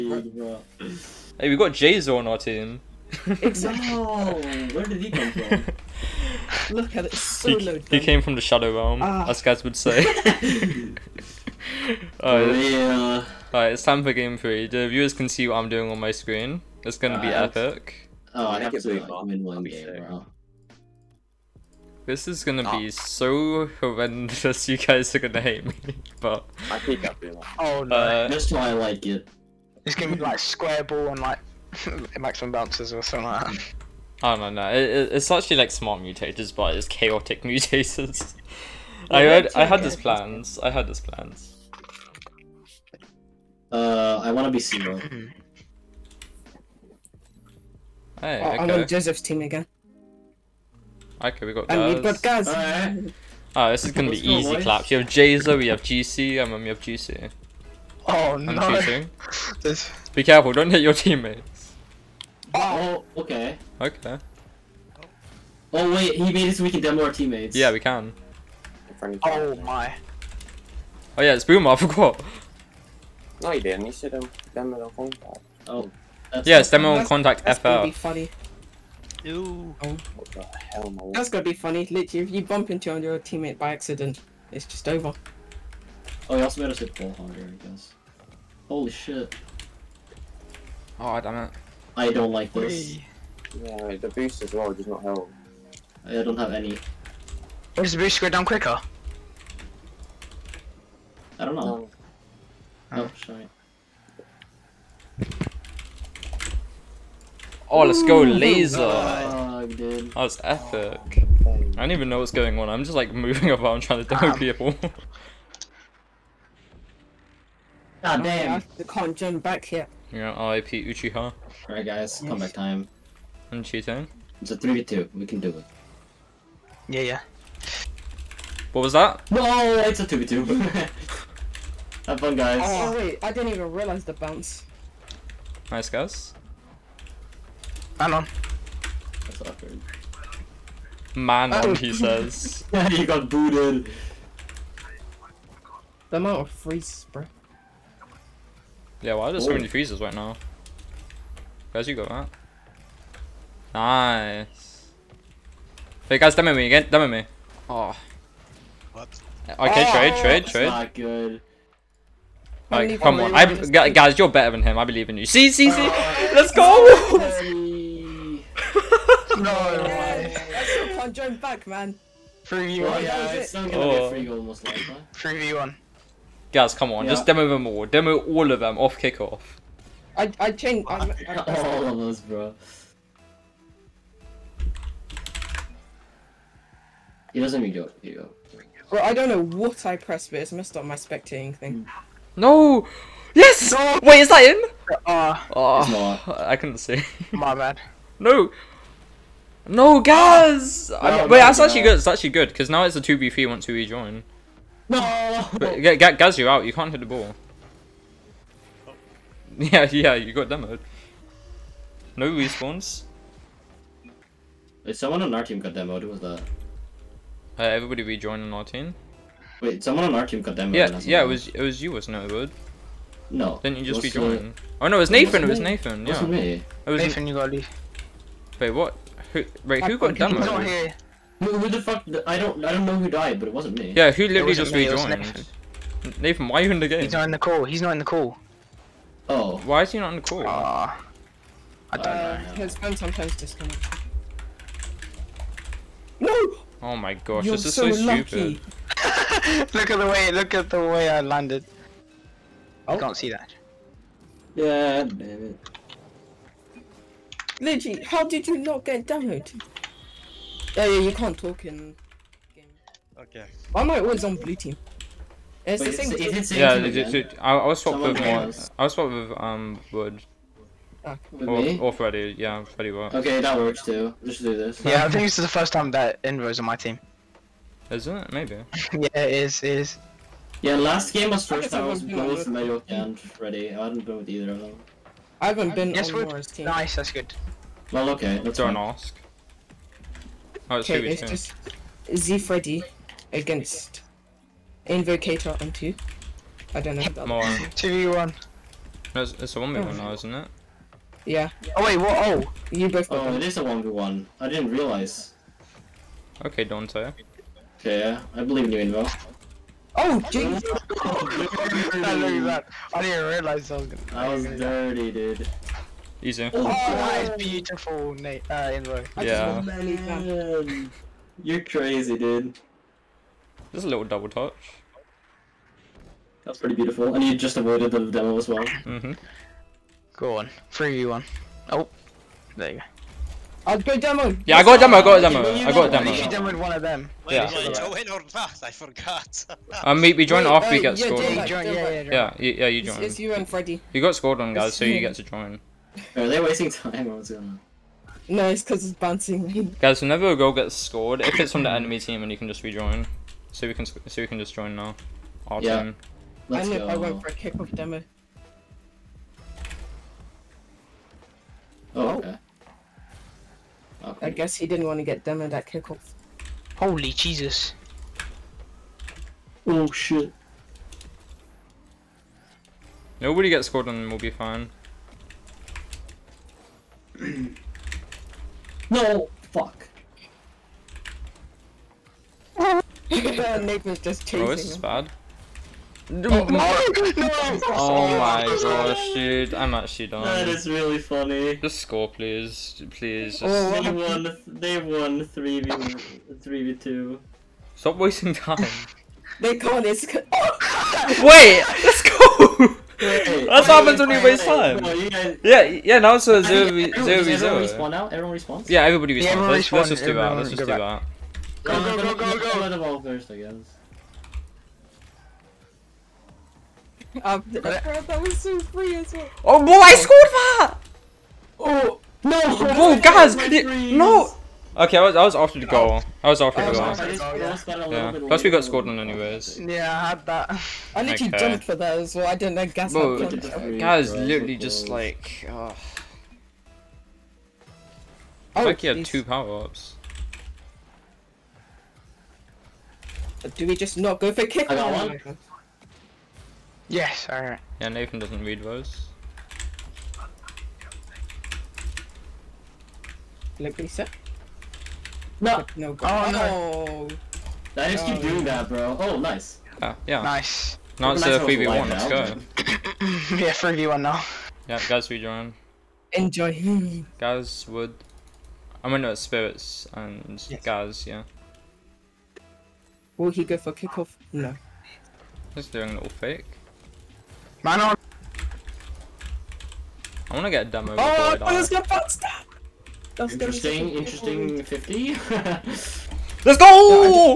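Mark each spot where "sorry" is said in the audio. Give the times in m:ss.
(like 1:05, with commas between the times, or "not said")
1:43.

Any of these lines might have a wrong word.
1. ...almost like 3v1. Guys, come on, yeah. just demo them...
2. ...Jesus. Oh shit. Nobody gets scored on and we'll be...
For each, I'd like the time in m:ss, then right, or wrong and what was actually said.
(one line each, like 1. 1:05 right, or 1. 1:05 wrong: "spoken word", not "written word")
1. 2:54 right
2. 6:07 right.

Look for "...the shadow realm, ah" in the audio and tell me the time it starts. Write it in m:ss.
0:08.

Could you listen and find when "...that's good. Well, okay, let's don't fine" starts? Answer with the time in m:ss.
4:46.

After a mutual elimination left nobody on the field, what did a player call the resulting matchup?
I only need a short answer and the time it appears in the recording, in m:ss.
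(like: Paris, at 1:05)
zero v zero v zero, at 6:46.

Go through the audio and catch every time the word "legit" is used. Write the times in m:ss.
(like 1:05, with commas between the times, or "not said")
4:17, 4:26.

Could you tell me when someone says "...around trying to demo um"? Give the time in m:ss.
1:53.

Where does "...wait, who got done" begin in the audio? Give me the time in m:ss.
3:49.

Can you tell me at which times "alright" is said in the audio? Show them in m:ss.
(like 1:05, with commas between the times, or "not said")
2:01, 7:27.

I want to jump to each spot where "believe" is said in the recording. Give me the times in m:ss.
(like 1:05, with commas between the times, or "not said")
2:44, 5:08.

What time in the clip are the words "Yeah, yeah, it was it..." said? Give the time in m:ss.
3:40.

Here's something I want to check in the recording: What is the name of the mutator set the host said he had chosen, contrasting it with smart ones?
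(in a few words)
chaotic mutators.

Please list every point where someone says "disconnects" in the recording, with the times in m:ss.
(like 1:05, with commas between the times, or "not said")
4:03.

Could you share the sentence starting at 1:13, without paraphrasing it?
He should have demo the phone Oh.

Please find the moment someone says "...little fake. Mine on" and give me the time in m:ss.
7:55.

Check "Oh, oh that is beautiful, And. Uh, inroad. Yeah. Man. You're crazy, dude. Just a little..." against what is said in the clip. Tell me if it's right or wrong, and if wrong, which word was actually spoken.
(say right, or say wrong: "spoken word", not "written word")
wrong: "Nate", not "And".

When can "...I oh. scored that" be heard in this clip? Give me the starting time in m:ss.
6:59.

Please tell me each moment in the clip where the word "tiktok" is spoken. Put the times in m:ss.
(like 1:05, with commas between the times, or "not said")
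not said.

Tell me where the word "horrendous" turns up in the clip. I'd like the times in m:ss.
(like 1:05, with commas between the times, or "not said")
0:23.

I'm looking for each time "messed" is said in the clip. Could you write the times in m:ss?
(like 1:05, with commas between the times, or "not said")
3:10.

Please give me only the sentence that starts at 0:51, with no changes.
Okay, we got I And we've got guys.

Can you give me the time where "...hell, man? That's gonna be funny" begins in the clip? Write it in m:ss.
1:20.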